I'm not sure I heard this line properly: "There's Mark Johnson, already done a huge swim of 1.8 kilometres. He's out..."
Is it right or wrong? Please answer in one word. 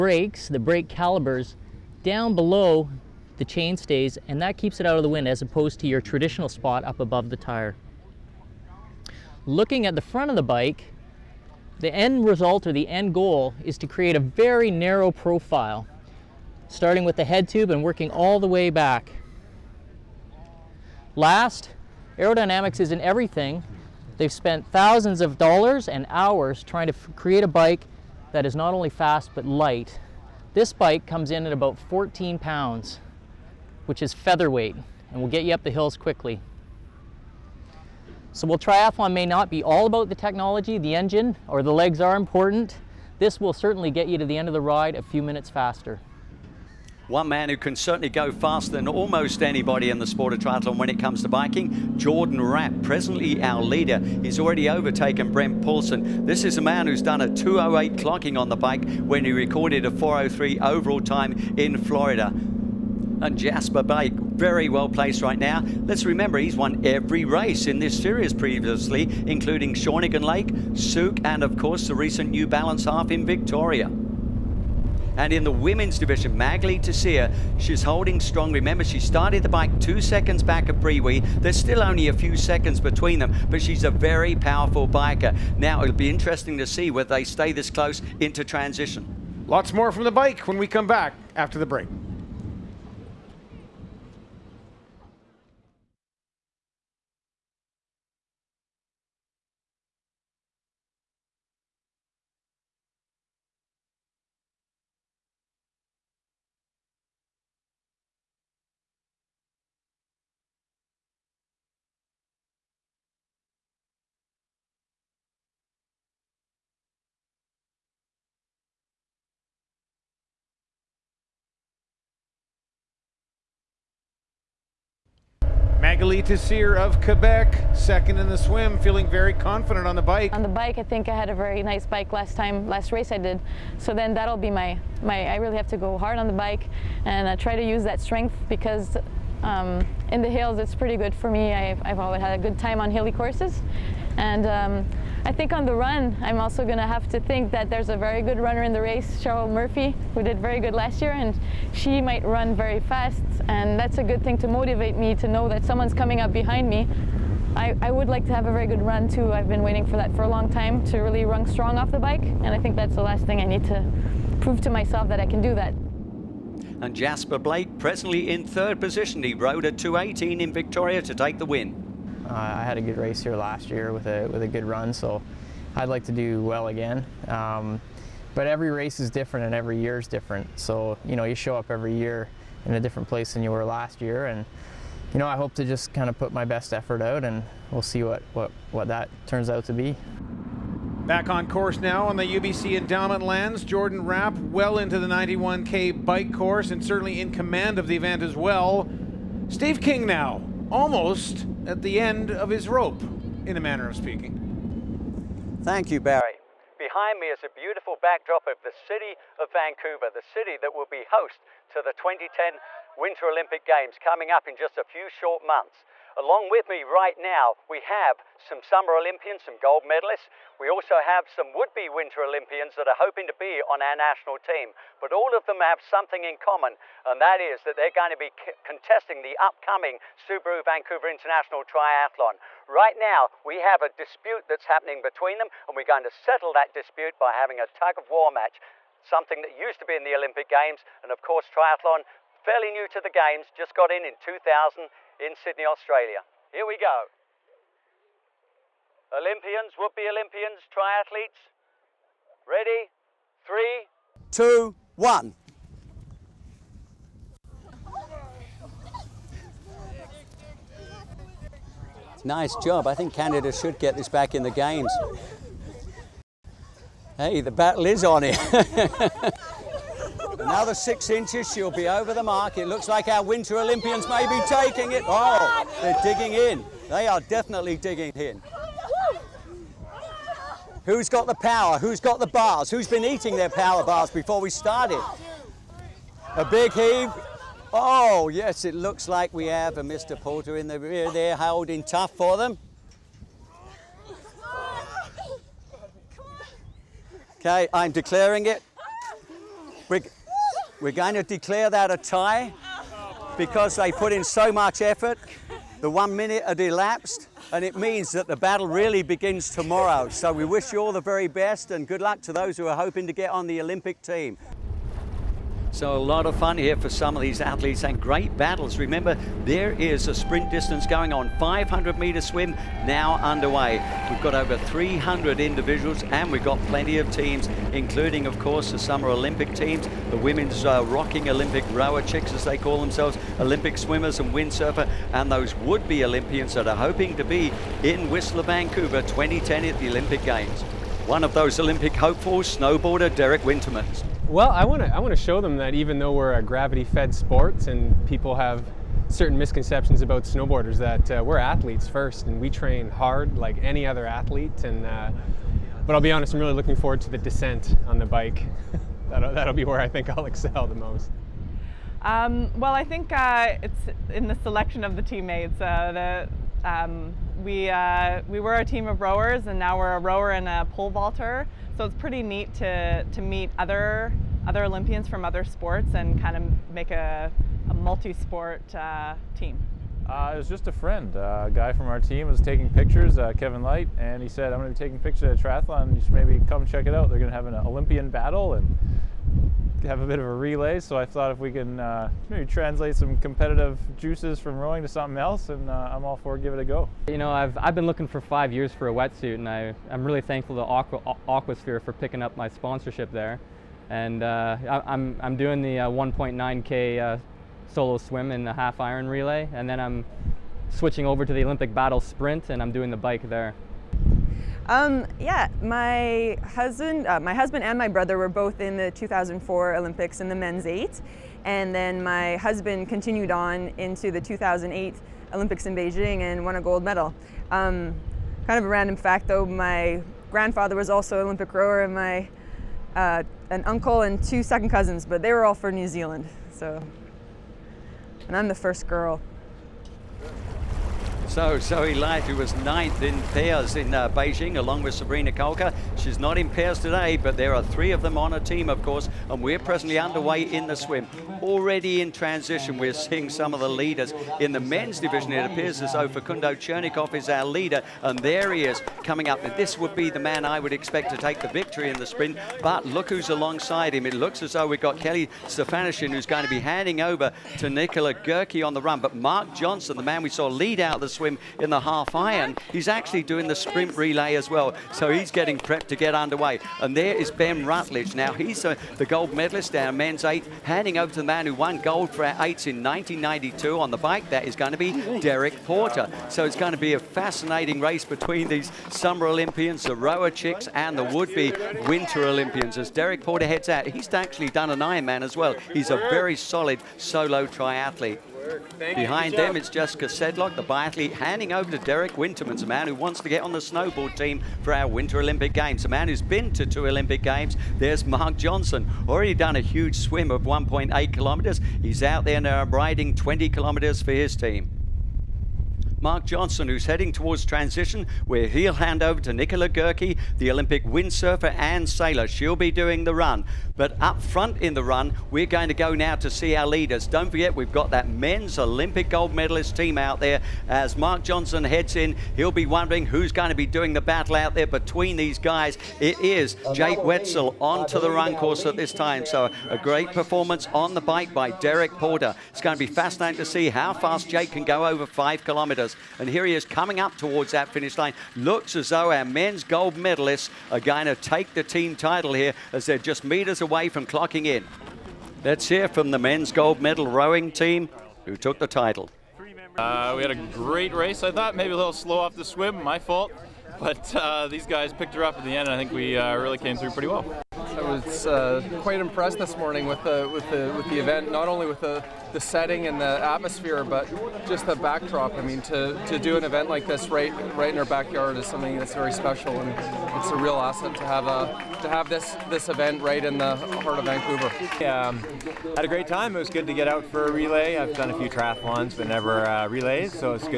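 right.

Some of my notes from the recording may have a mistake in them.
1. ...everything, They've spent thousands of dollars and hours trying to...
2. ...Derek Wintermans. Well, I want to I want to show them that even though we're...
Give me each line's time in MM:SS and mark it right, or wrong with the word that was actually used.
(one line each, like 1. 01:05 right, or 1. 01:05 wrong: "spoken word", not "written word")
1. 00:23 right
2. 05:43 right.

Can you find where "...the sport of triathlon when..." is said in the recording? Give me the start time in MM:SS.
00:49.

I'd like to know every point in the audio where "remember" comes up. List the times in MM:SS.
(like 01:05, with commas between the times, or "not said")
01:06, 01:18, 05:18.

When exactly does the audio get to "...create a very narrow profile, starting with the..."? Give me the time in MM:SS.
00:13.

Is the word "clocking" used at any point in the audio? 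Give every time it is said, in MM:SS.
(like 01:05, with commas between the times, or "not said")
00:57, 09:14.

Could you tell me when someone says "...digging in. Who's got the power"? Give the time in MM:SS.
04:37.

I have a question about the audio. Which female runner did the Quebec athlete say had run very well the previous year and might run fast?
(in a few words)
Cheryl Murphy.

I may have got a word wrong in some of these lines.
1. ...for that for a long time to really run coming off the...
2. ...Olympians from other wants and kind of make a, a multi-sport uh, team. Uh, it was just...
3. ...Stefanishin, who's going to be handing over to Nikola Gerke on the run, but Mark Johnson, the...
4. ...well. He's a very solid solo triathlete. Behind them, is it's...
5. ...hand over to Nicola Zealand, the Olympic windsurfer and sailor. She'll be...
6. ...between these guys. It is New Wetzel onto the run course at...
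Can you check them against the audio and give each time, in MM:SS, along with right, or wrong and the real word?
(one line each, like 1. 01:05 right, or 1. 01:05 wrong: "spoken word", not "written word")
1. 02:39 wrong: "strong", not "coming"
2. 06:14 wrong: "sports", not "wants"
3. 07:45 right
4. 08:15 right
5. 08:38 wrong: "Gerke", not "Zealand"
6. 08:54 wrong: "Jake", not "New".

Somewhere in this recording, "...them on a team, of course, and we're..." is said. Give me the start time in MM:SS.
07:28.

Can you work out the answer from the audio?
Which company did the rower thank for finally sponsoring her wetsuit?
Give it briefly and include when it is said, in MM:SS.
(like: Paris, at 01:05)
Aquasphere, at 06:41.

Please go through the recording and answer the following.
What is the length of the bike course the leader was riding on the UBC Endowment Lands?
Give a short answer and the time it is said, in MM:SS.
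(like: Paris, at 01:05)
91K, at 03:15.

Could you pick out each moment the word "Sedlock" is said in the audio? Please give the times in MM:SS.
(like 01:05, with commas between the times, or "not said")
08:20.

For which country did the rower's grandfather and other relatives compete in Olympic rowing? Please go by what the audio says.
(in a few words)
New Zealand.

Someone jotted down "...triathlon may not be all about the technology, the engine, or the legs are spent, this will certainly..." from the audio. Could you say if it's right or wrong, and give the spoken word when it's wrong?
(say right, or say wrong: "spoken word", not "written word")
wrong: "important", not "spent".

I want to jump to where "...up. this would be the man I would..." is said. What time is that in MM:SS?
07:39.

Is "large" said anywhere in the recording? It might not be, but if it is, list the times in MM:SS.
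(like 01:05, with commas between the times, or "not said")
not said.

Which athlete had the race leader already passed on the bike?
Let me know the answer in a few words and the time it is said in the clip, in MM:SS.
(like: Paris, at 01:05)
Brent Paulson, at 00:55.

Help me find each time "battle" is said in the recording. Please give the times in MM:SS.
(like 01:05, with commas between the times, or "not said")
04:27, 05:08, 05:18, 06:28, 06:51, 08:54.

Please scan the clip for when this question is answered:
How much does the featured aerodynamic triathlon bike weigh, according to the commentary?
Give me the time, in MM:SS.
00:31.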